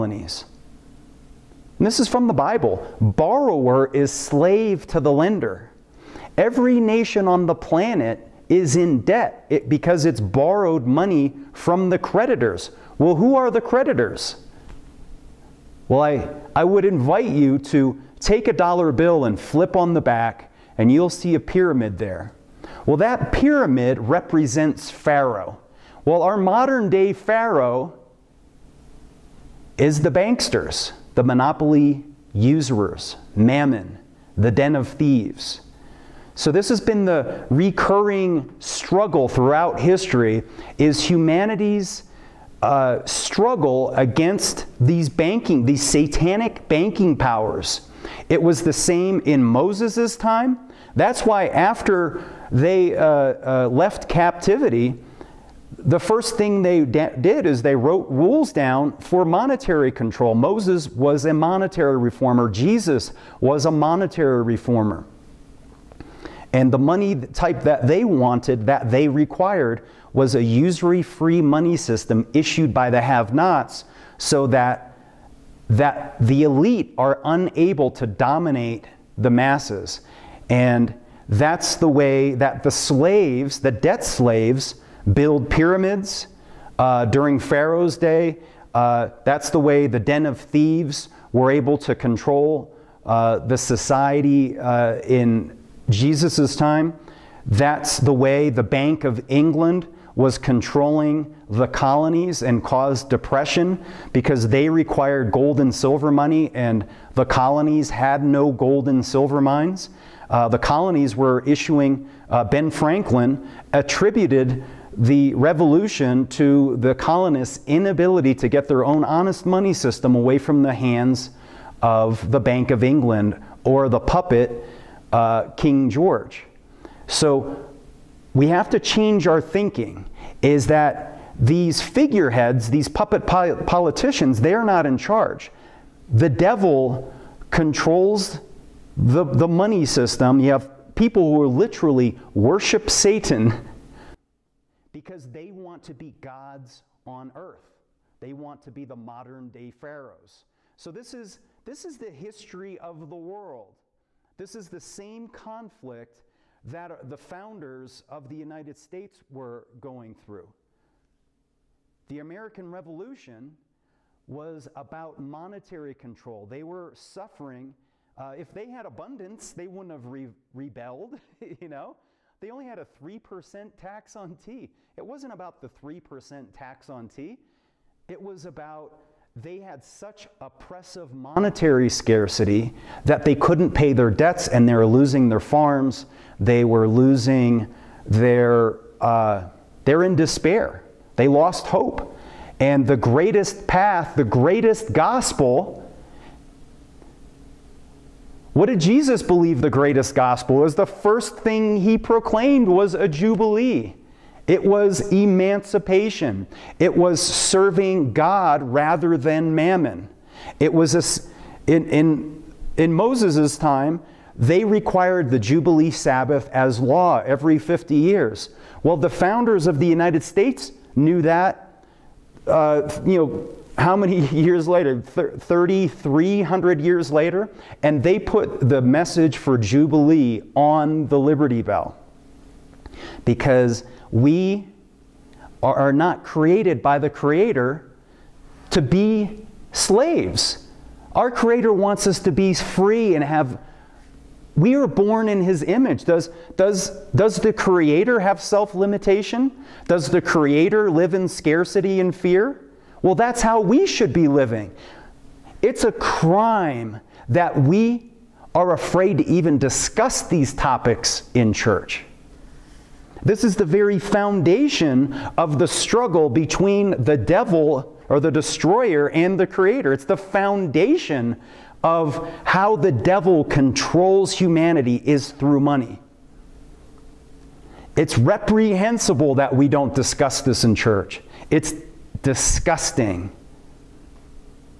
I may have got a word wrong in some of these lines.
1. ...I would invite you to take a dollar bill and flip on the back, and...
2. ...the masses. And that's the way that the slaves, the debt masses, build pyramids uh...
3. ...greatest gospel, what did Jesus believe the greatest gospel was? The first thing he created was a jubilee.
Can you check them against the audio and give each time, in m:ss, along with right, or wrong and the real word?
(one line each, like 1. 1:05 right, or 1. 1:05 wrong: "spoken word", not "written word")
1. 0:16 right
2. 1:19 wrong: "slaves", not "masses"
3. 3:14 wrong: "proclaimed", not "created".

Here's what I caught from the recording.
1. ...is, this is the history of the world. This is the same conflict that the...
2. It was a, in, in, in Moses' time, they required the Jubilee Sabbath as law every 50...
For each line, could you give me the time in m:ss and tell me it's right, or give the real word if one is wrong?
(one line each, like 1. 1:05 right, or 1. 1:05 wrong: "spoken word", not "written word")
1. 2:31 right
2. 3:30 right.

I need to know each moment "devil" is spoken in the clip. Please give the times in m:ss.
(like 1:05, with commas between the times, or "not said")
2:16, 4:27, 4:32.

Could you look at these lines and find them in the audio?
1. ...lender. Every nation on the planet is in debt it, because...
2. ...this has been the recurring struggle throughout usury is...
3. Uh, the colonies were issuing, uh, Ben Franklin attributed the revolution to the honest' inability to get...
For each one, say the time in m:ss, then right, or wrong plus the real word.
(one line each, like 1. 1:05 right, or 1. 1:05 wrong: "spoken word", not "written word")
1. 0:05 right
2. 0:36 wrong: "history", not "usury"
3. 1:50 wrong: "colonists", not "honest".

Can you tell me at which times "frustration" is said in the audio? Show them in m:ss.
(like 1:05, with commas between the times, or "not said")
not said.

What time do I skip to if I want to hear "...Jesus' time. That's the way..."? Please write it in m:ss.
1:35.